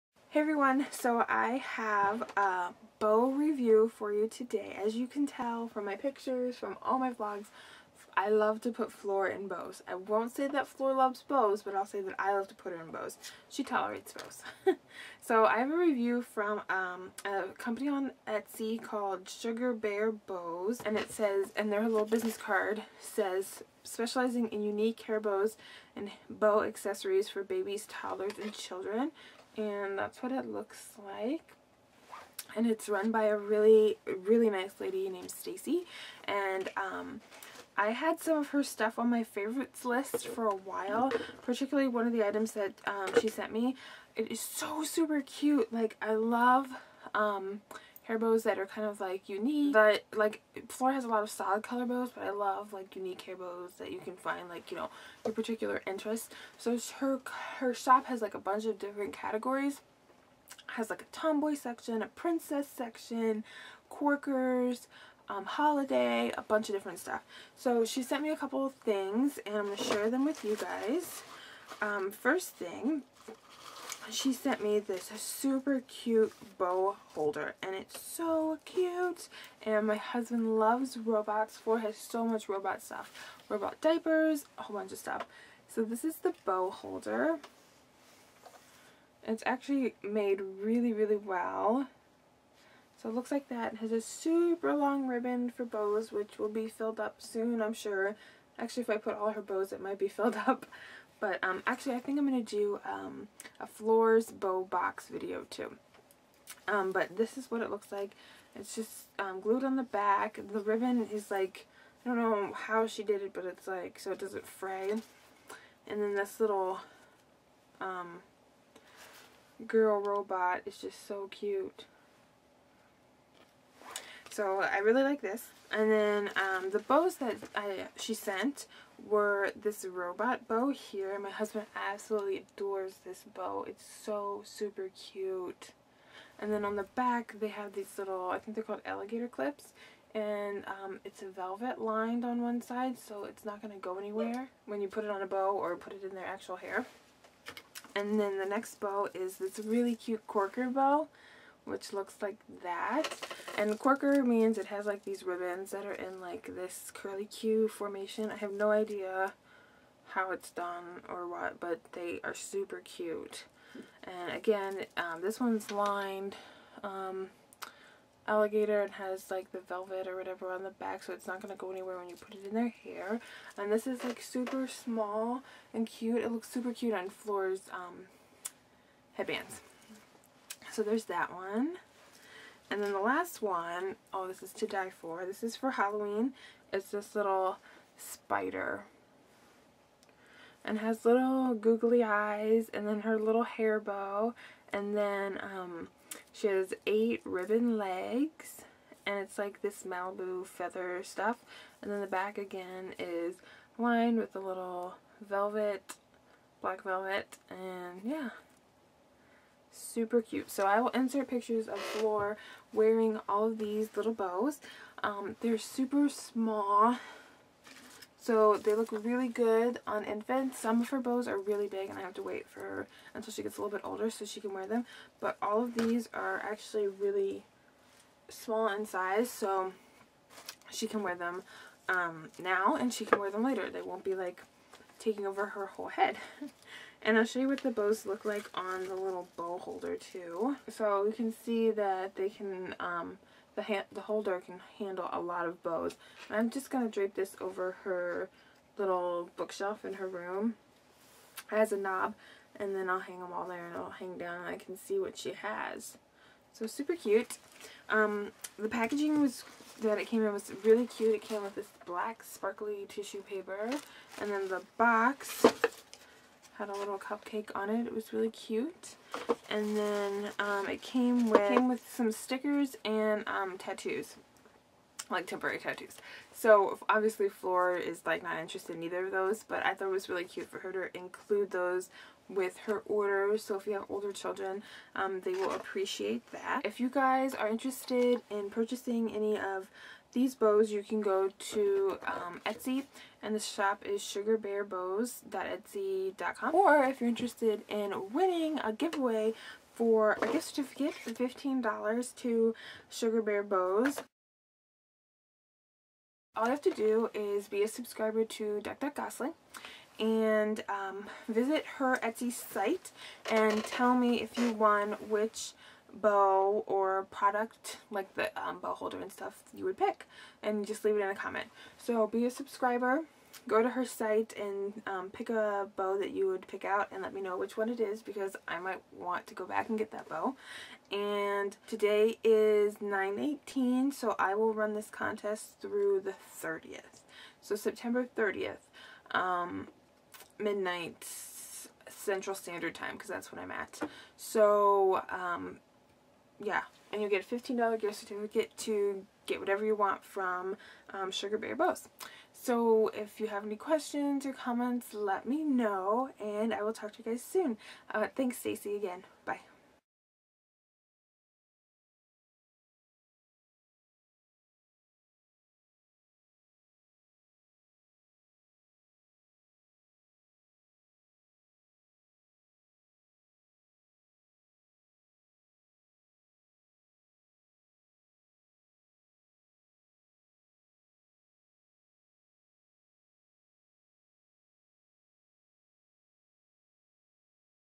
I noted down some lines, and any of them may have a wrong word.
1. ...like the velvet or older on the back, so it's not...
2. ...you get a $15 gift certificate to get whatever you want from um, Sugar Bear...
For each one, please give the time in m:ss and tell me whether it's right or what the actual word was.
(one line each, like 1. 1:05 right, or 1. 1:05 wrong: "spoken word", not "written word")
1. 2:49 wrong: "whatever", not "older"
2. 5:47 right.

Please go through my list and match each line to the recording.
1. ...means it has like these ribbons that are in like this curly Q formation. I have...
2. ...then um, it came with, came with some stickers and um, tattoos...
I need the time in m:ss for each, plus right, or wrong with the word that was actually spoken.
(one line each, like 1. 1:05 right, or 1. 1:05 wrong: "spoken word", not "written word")
1. 2:34 right
2. 4:29 right.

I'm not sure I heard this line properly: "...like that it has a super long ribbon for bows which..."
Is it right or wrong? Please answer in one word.
right.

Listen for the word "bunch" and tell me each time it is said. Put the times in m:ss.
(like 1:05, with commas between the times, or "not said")
0:58, 1:06, 1:24.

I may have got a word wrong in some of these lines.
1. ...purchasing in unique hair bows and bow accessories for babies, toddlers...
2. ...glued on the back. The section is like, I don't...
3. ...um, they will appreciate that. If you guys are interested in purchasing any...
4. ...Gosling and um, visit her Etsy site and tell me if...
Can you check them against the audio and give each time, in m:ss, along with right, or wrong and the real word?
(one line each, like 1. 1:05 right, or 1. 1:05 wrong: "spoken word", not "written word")
1. 0:23 wrong: "specializing", not "purchasing"
2. 1:49 wrong: "ribbon", not "section"
3. 4:44 right
4. 5:08 right.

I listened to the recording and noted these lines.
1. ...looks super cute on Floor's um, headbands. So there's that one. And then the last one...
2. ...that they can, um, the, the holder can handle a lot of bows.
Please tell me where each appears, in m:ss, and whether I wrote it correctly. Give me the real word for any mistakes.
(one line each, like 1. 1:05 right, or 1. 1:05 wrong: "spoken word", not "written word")
1. 2:56 right
2. 4:01 right.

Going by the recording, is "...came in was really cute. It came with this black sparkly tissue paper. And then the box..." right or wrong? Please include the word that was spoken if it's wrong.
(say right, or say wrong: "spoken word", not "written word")
right.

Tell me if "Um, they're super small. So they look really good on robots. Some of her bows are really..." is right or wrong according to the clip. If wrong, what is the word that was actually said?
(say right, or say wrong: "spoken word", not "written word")
wrong: "infants", not "robots".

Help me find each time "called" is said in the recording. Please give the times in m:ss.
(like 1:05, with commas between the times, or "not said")
0:18, 2:18.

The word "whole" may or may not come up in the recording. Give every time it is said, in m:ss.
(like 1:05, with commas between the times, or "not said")
1:24, 3:55.